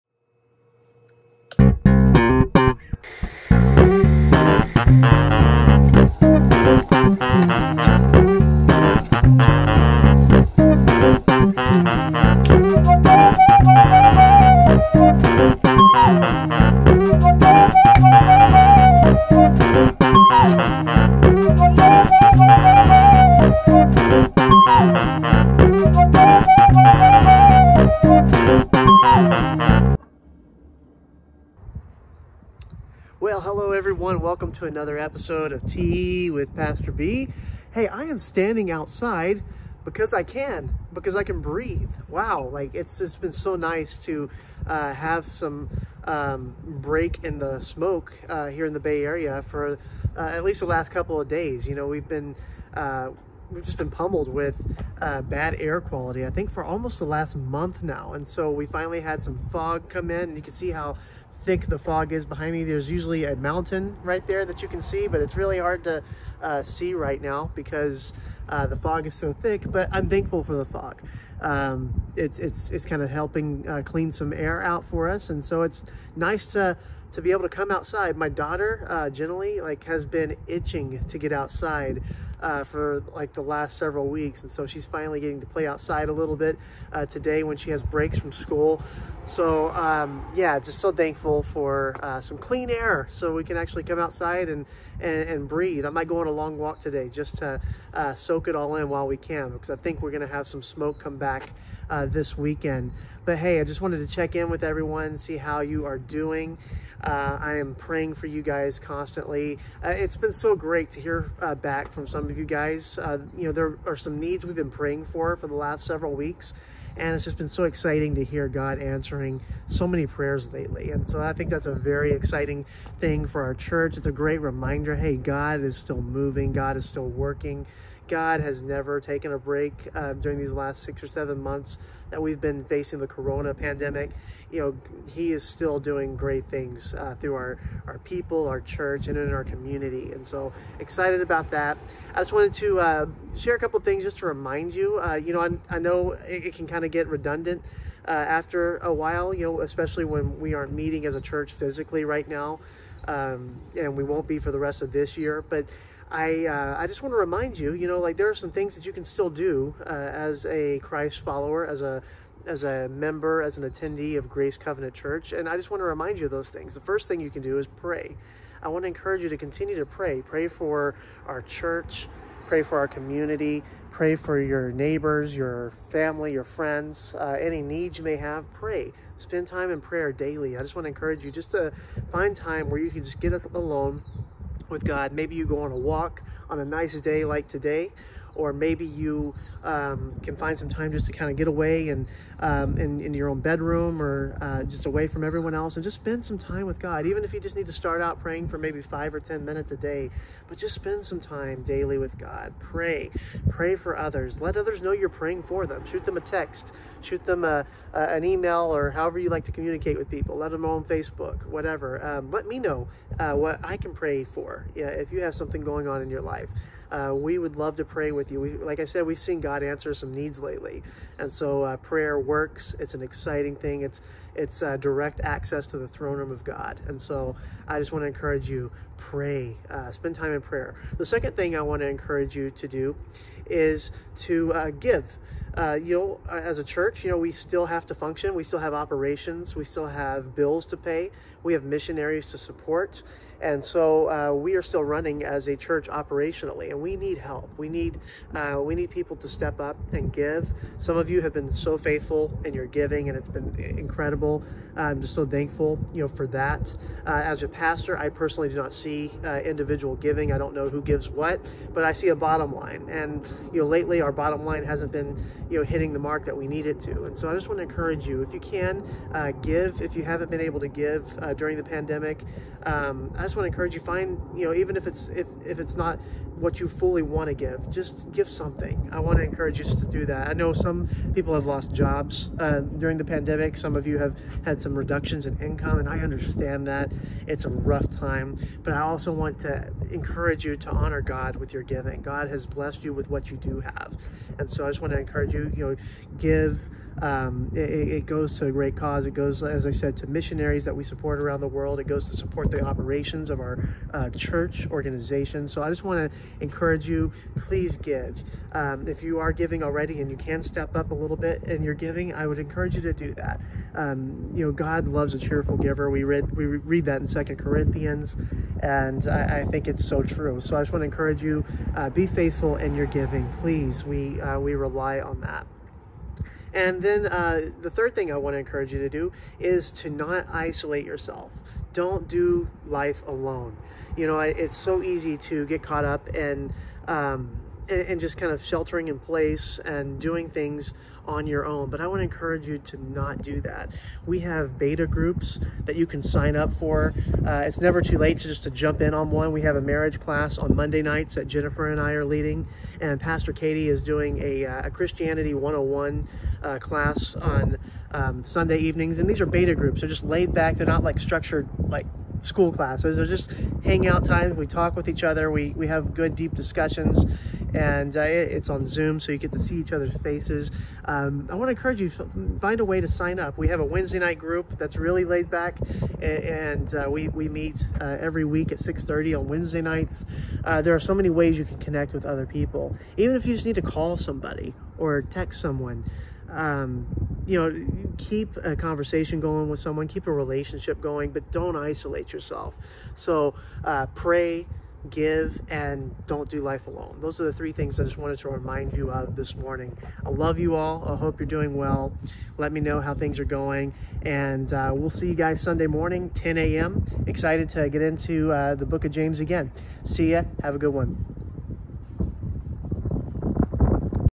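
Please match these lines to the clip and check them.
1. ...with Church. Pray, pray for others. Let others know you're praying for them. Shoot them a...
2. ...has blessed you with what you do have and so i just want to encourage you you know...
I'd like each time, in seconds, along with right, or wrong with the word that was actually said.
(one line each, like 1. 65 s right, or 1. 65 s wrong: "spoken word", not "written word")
1. 201 s wrong: "God", not "Church"
2. 292 s right.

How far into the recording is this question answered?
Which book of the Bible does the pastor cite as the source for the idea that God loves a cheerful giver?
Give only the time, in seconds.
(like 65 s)
317 s.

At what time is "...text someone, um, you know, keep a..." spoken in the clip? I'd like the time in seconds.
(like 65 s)
385 s.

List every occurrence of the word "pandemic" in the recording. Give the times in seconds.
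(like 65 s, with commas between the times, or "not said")
133 s, 271 s, 283 s.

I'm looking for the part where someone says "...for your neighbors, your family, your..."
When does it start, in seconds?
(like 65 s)
174 s.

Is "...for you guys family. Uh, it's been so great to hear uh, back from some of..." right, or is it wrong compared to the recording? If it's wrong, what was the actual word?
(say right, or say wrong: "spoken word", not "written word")
wrong: "constantly", not "family".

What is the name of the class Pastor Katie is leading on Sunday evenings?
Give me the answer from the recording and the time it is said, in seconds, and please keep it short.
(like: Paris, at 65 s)
Christianity 101, at 354 s.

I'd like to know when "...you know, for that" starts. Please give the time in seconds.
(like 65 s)
255 s.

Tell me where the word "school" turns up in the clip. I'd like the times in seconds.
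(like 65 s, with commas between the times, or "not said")
88 s, 362 s.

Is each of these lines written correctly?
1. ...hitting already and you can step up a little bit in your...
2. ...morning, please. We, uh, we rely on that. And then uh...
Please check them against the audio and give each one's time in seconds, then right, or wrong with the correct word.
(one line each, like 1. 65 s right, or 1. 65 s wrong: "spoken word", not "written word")
1. 309 s wrong: "giving", not "hitting"
2. 322 s wrong: "giving", not "morning".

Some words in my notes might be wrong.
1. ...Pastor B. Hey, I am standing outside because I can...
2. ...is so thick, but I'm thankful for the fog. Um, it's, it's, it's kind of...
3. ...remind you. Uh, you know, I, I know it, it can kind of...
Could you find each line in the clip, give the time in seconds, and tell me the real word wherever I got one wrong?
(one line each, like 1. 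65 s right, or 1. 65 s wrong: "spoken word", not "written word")
1. 36 s right
2. 69 s right
3. 144 s right.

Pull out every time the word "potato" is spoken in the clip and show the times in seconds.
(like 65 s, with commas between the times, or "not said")
not said.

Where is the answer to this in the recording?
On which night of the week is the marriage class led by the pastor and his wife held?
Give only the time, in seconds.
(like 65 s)
350 s.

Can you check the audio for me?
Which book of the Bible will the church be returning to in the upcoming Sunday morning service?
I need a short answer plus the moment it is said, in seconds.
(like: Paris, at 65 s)
James, at 408 s.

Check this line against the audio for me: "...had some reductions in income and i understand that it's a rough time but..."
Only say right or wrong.
right.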